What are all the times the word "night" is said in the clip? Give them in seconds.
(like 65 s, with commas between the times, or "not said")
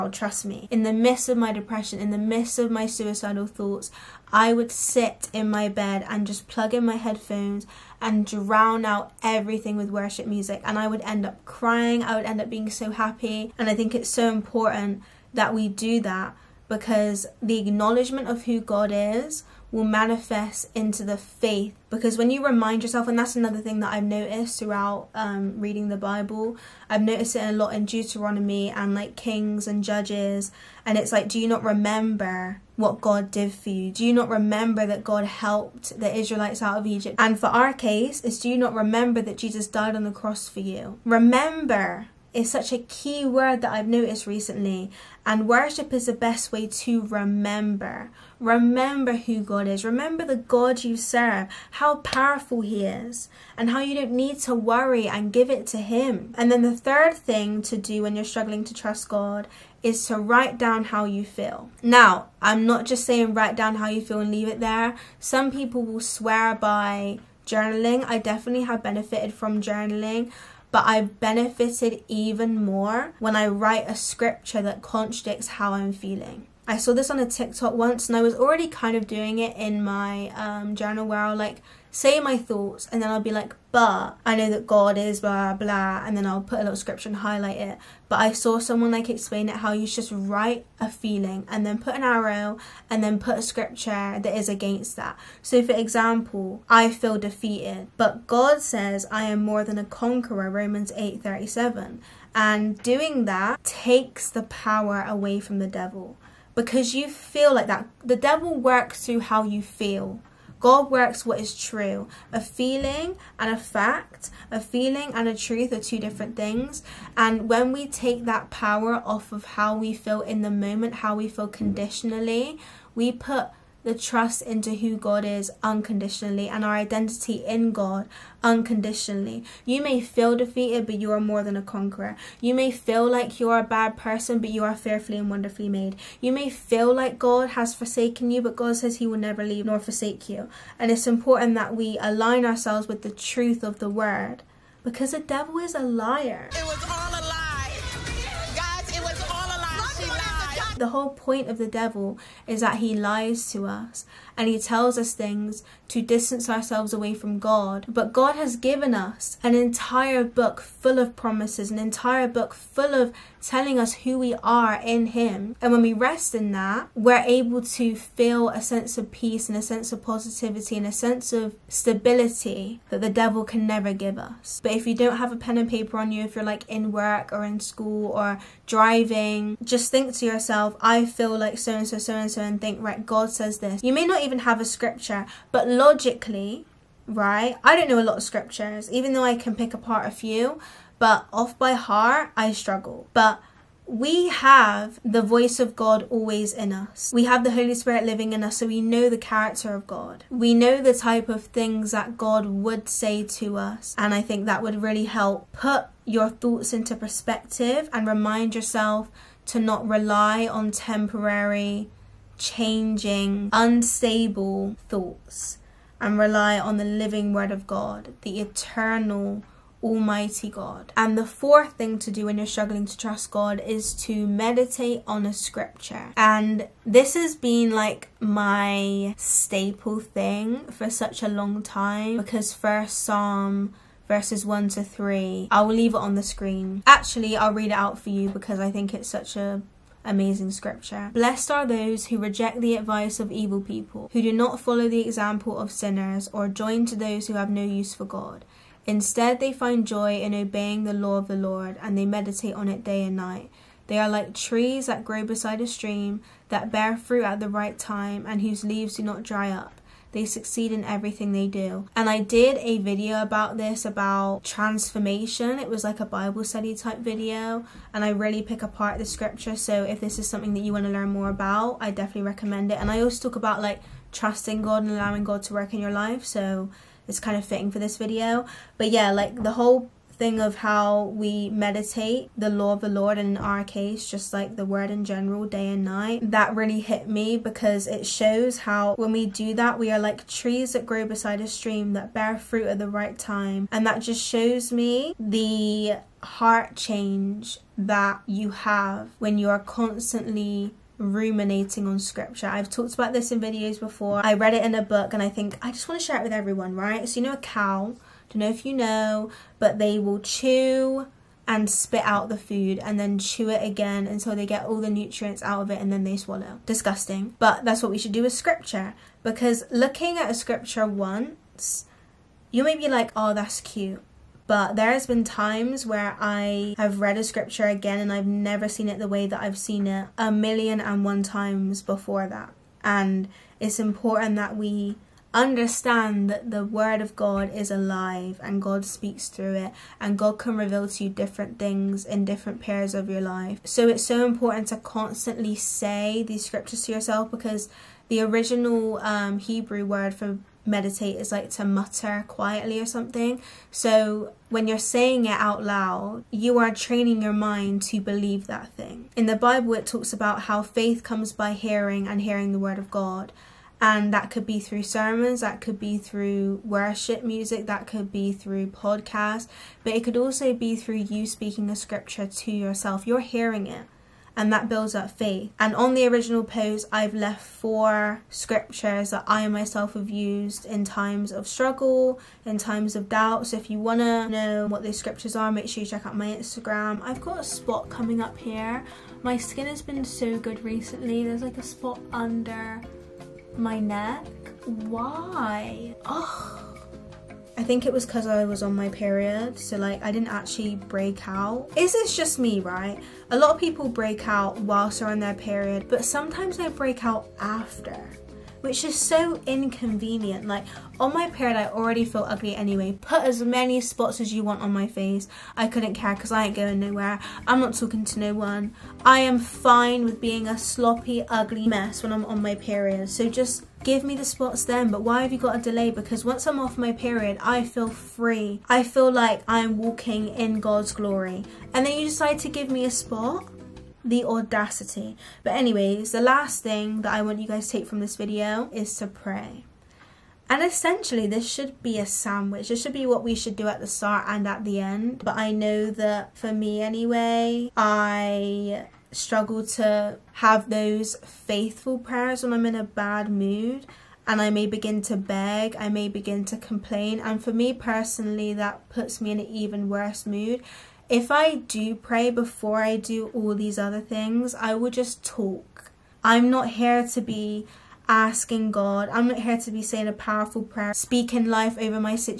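253 s, 285 s.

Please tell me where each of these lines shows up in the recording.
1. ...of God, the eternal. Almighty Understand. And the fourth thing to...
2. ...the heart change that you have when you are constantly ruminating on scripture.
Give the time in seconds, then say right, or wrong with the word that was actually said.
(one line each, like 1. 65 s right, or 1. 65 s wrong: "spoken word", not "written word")
1. 217 s wrong: "God", not "Understand"
2. 295 s right.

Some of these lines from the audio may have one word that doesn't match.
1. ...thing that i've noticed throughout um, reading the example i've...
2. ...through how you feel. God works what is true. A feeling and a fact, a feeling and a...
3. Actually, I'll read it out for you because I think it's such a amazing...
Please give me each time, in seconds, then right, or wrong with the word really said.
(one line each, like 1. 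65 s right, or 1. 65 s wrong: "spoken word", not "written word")
1. 23 s wrong: "bible", not "example"
2. 109 s right
3. 236 s right.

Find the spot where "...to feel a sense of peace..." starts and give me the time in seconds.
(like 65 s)
167 s.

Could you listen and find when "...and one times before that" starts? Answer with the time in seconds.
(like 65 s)
330 s.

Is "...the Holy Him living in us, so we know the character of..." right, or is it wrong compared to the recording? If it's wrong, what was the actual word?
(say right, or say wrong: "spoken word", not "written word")
wrong: "Spirit", not "Him".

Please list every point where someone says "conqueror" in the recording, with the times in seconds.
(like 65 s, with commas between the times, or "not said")
99 s, 131 s.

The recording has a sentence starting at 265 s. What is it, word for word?
It was like a Bible study type video, and I really pick apart the scripture.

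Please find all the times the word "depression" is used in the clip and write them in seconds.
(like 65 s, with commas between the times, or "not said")
1 s.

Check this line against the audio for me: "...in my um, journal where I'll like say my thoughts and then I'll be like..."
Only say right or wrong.
right.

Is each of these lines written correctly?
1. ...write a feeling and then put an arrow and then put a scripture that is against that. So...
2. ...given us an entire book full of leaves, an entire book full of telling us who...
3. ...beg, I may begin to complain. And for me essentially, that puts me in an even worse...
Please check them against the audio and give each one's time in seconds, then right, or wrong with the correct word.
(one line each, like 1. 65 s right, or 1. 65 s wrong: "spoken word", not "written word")
1. 90 s right
2. 158 s wrong: "promises", not "leaves"
3. 455 s wrong: "personally", not "essentially".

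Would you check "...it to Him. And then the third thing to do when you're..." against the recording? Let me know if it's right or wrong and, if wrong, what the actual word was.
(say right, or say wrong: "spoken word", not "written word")
right.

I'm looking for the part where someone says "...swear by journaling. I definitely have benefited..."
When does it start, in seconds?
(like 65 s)
65 s.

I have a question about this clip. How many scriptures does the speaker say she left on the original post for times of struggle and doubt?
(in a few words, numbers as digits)
4.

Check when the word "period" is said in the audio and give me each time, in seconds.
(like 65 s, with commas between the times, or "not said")
342 s, 398 s, 405 s, 411 s, 422 s, 426 s.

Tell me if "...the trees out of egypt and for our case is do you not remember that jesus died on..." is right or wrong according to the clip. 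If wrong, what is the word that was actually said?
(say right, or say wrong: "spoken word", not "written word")
wrong: "israelites", not "trees".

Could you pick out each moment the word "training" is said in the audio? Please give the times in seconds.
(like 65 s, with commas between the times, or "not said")
356 s.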